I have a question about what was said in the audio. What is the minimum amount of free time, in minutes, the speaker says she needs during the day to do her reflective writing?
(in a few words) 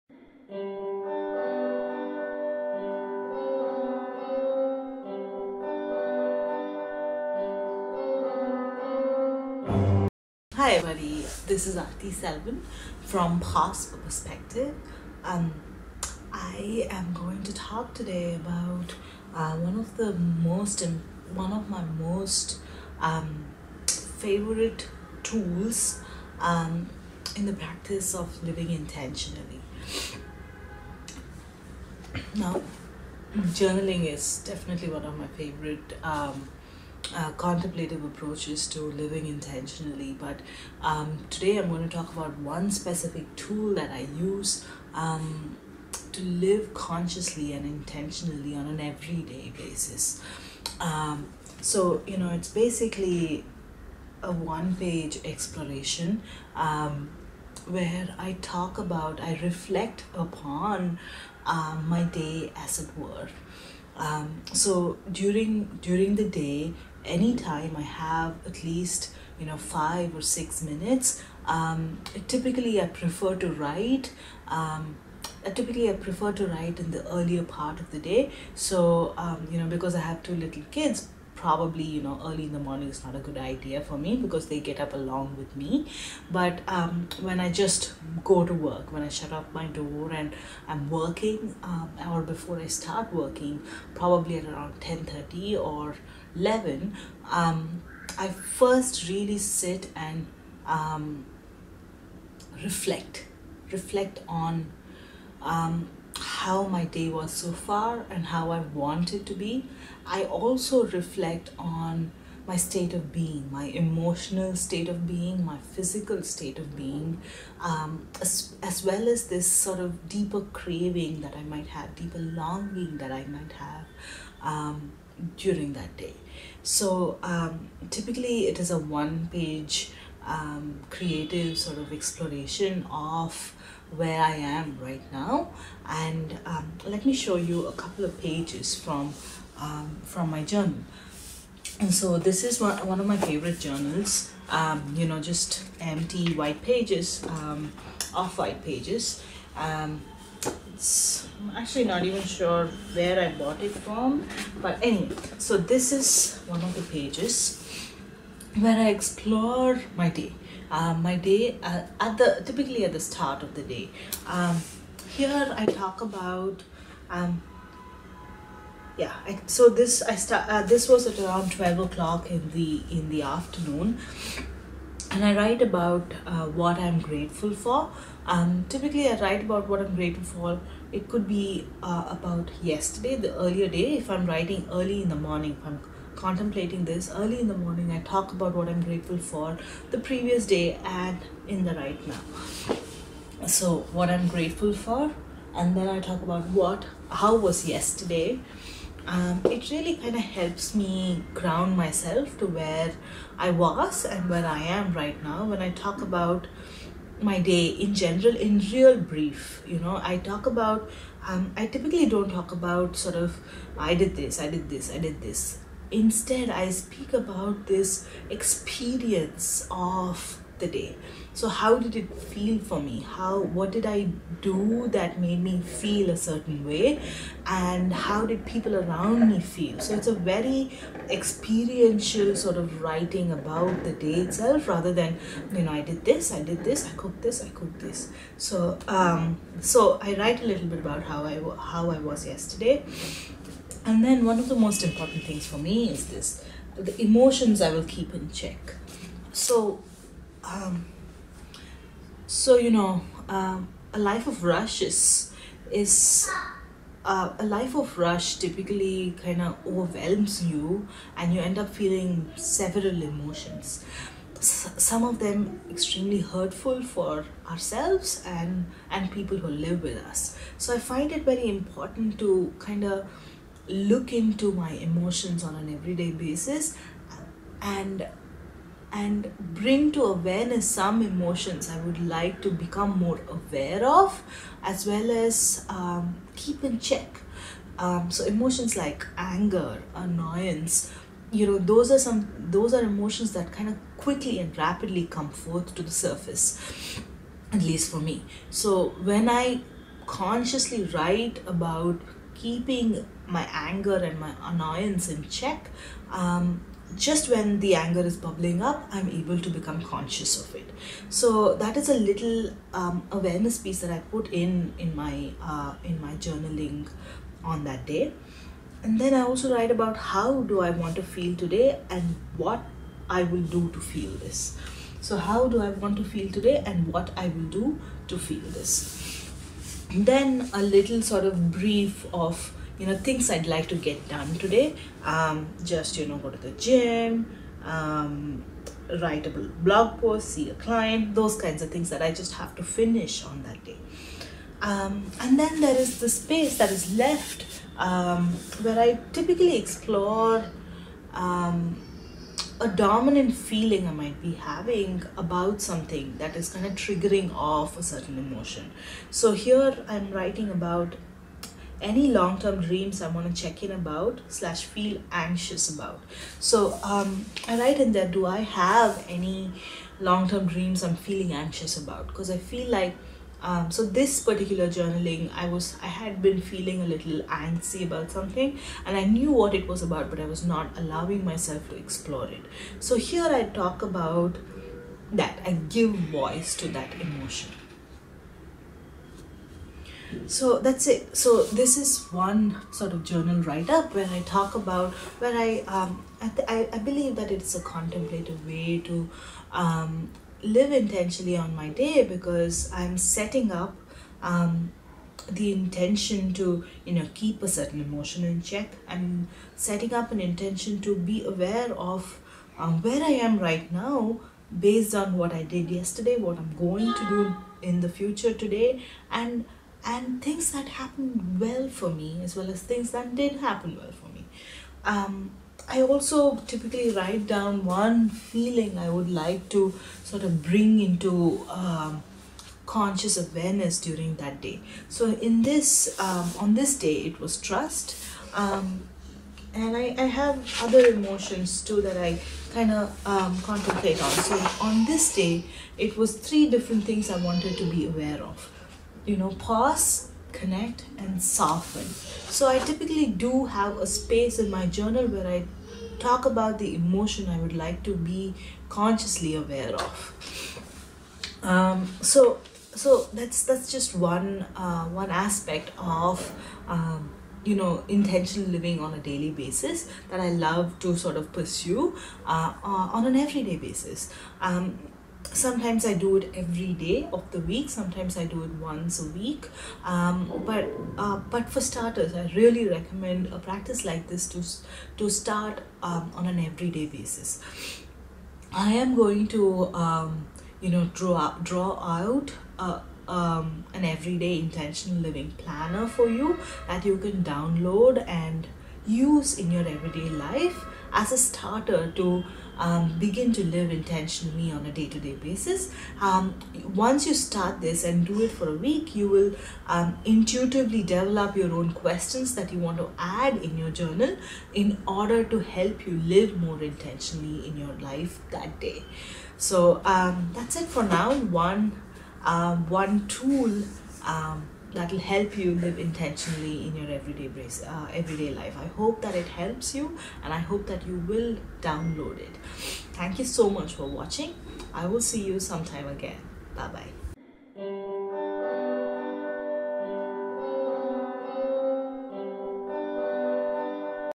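5 or 6 minutes.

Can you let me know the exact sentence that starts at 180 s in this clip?
It could be uh, about yesterday, the earlier day.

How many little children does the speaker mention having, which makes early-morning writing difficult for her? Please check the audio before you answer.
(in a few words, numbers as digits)
2.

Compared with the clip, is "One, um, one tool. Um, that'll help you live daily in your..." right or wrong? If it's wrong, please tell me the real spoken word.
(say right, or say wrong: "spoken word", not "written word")
wrong: "intentionally", not "daily".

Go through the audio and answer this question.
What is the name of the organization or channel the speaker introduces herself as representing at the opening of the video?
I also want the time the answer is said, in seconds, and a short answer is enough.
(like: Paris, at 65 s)
Past Perspective, at 13 s.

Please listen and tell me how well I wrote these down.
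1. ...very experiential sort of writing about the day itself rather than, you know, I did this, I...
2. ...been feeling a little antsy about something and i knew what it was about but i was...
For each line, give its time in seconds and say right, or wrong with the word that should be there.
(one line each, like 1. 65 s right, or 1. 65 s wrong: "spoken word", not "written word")
1. 230 s right
2. 376 s right.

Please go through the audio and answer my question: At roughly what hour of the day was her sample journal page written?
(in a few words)
12 o'clock.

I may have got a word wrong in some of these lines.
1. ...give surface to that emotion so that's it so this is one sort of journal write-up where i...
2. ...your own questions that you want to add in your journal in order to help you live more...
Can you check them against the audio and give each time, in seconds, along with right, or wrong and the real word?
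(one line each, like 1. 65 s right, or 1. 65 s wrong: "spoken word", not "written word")
1. 385 s wrong: "voice", not "surface"
2. 511 s right.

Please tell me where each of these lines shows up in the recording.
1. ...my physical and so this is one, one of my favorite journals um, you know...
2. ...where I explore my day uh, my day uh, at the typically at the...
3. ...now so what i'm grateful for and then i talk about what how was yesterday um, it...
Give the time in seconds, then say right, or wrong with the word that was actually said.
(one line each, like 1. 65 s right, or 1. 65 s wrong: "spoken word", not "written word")
1. 140 s wrong: "journal", not "physical"
2. 158 s right
3. 192 s right.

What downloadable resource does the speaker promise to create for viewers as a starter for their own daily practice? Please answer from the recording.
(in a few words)
Everyday intentional living planner.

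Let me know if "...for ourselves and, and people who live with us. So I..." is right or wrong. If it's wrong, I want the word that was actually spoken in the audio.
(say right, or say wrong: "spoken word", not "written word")
right.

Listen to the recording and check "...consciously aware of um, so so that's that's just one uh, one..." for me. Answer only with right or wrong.
right.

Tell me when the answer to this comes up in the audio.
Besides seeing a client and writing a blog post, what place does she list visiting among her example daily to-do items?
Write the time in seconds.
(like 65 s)
336 s.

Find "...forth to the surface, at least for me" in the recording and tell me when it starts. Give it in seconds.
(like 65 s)
295 s.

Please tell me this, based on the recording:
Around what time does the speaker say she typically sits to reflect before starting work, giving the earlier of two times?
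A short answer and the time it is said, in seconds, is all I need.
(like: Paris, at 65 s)
10:30, at 94 s.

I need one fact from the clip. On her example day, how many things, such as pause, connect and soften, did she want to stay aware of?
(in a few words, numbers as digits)
3.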